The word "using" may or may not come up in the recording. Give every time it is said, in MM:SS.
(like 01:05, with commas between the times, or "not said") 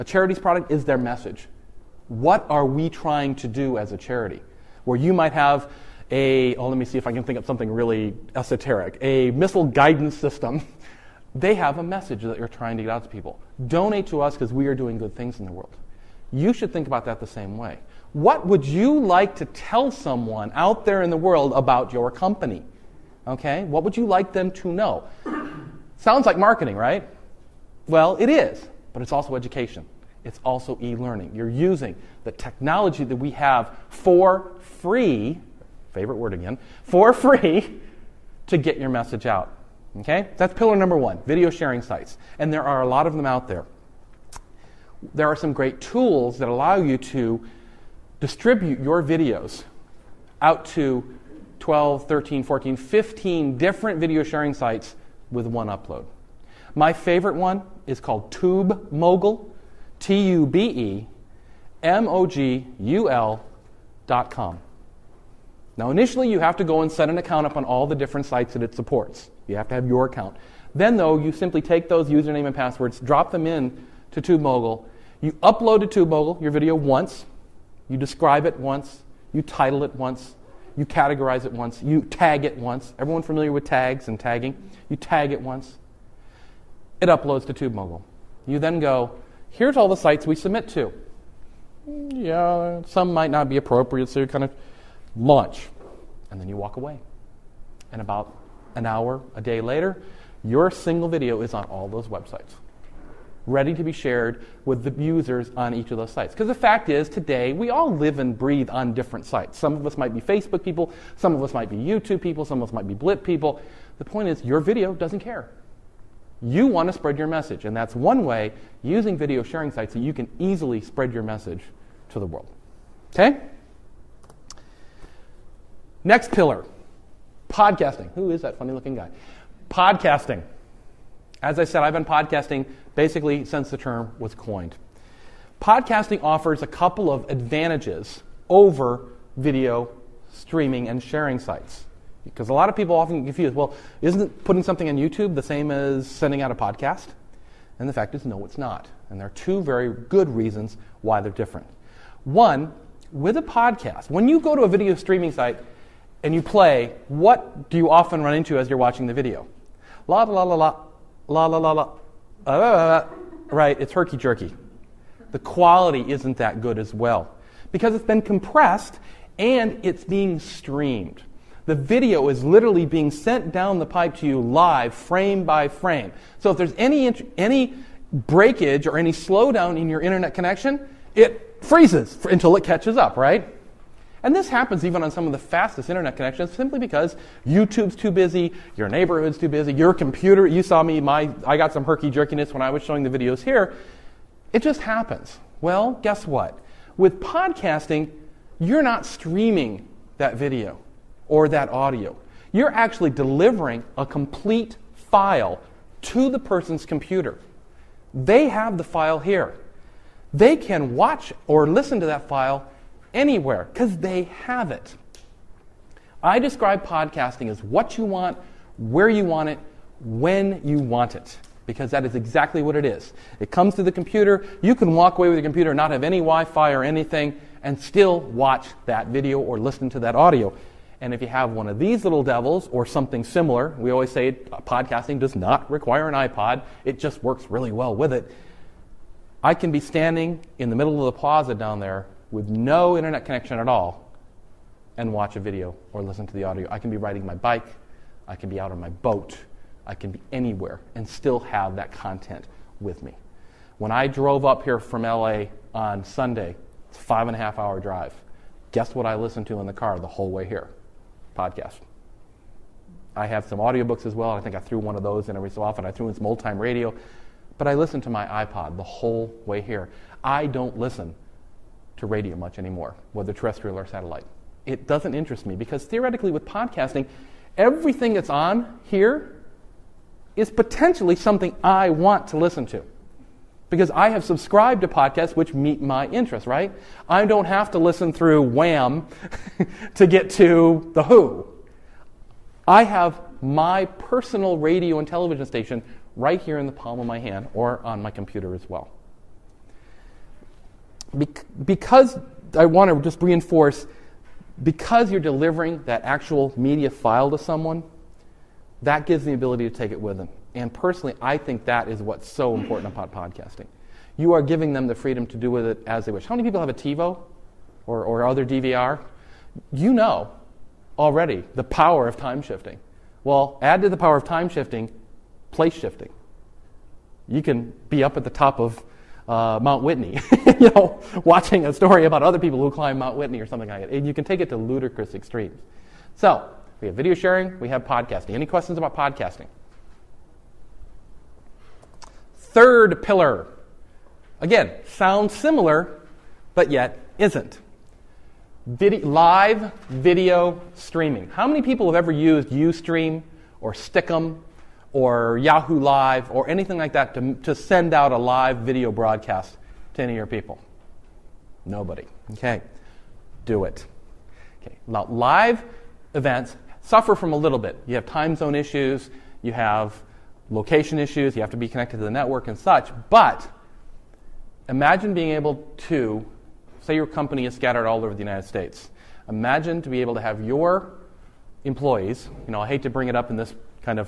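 00:31, 01:58.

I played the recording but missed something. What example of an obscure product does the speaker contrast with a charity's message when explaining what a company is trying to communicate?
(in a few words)
missile guidance system.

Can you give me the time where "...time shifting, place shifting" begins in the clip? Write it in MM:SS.
05:24.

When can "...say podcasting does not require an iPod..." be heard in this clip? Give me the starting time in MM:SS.
03:54.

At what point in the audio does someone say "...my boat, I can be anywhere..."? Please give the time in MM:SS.
04:08.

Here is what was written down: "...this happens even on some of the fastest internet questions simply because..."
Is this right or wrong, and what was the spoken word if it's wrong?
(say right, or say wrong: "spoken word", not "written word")
wrong: "connections", not "questions".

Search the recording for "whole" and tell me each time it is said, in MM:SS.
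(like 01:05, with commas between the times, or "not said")
04:20, 04:28.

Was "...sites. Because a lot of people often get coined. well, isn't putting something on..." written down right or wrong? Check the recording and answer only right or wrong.
wrong.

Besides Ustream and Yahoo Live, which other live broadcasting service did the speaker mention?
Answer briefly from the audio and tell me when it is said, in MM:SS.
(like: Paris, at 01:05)
Stickam, at 05:53.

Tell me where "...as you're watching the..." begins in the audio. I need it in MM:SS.
02:38.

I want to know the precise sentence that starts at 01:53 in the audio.
The point is, your video doesn't care.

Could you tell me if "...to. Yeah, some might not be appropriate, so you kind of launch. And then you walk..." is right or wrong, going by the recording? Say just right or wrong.
right.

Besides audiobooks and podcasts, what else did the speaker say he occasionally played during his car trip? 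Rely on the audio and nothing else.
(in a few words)
old time radio.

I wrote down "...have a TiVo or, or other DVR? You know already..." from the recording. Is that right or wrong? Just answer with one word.
right.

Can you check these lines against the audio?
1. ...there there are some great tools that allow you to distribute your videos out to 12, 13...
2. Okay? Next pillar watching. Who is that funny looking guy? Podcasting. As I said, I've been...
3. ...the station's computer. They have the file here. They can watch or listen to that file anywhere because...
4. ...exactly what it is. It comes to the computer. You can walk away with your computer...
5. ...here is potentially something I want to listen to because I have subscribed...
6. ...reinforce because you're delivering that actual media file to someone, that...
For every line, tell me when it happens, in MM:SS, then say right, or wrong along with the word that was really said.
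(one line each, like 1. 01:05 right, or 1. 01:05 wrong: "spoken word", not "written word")
1. 00:43 right
2. 02:03 wrong: "podcasting", not "watching"
3. 03:26 wrong: "person", not "station"
4. 03:42 right
5. 04:38 right
6. 05:03 right.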